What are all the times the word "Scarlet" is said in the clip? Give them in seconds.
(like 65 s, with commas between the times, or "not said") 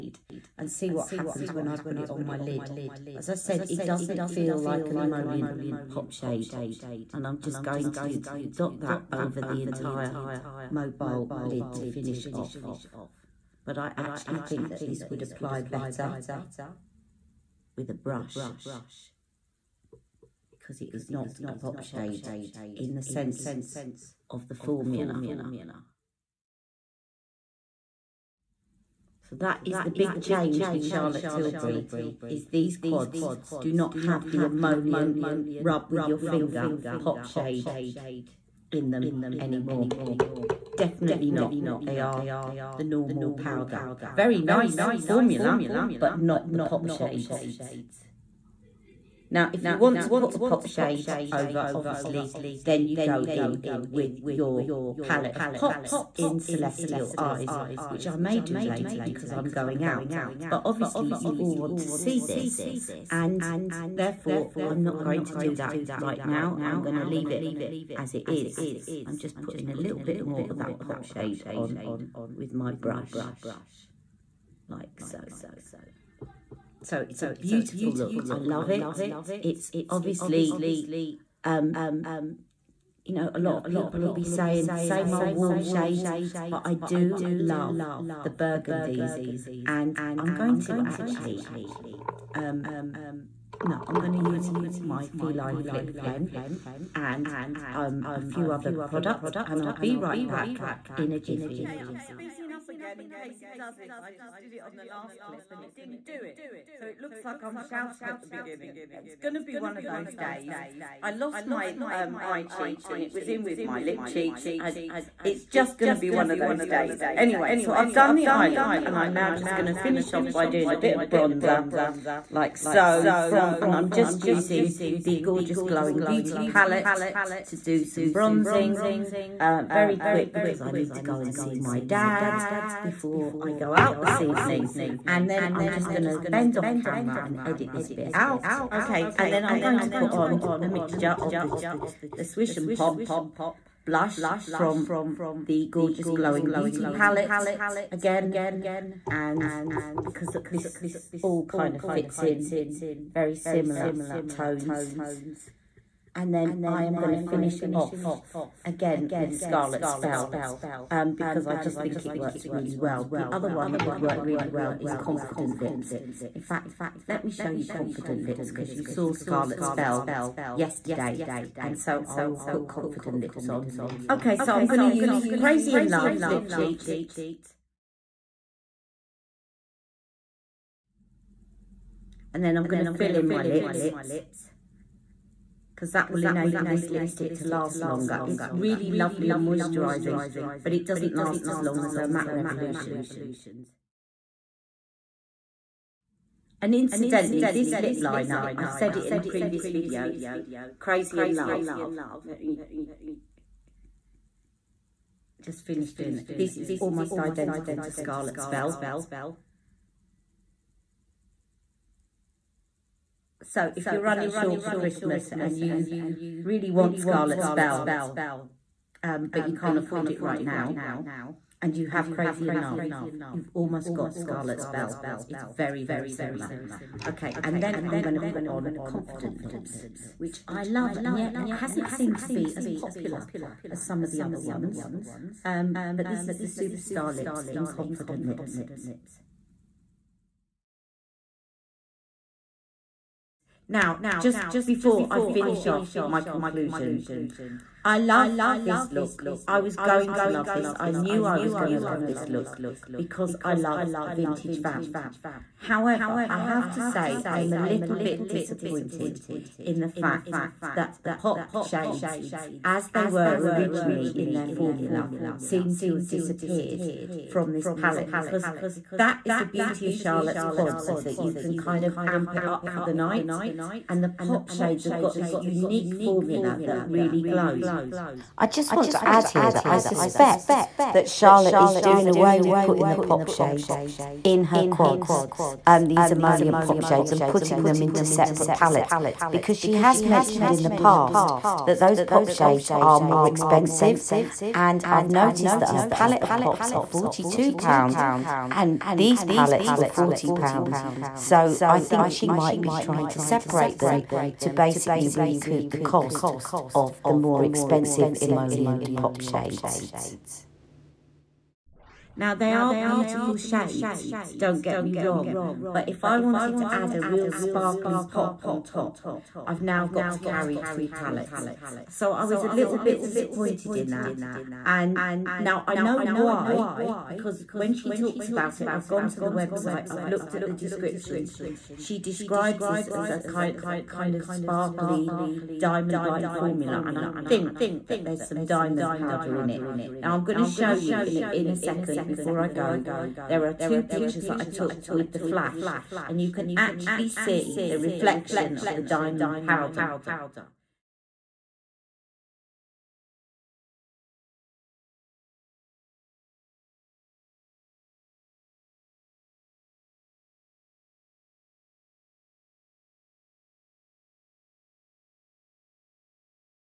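159 s, 169 s, 207 s, 216 s, 224 s.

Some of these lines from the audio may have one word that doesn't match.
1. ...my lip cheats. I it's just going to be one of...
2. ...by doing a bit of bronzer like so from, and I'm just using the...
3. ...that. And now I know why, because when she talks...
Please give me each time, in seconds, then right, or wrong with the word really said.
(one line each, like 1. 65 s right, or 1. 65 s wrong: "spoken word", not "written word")
1. 113 s right
2. 120 s right
3. 323 s right.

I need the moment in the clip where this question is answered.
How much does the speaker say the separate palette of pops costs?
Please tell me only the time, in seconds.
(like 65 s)
296 s.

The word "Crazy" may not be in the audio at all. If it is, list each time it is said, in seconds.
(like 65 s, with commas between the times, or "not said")
175 s, 200 s, 222 s.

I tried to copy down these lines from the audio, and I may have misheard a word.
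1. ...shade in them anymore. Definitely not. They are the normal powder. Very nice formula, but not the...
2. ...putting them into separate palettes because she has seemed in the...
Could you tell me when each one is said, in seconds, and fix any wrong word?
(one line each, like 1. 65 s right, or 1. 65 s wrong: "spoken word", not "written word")
1. 37 s right
2. 287 s wrong: "mentioned", not "seemed".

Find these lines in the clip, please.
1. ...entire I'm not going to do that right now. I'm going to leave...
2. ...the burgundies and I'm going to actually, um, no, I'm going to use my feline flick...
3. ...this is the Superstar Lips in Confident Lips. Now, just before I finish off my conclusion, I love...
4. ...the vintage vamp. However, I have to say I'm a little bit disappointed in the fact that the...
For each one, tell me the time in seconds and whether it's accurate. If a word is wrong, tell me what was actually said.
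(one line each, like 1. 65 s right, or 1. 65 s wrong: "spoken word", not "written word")
1. 63 s wrong: "therefore", not "entire"
2. 88 s right
3. 236 s right
4. 254 s right.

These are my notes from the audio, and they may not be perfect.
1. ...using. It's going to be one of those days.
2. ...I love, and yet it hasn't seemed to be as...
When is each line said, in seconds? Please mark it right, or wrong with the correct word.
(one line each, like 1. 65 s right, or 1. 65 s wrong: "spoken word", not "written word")
1. 108 s wrong: "beginning", not "using"
2. 230 s right.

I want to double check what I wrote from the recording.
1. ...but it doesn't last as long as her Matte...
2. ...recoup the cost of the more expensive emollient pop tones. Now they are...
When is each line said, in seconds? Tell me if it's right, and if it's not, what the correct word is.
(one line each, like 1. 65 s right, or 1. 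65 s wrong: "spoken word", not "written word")
1. 190 s right
2. 305 s wrong: "shades", not "tones".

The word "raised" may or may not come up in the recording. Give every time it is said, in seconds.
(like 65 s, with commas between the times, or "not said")
not said.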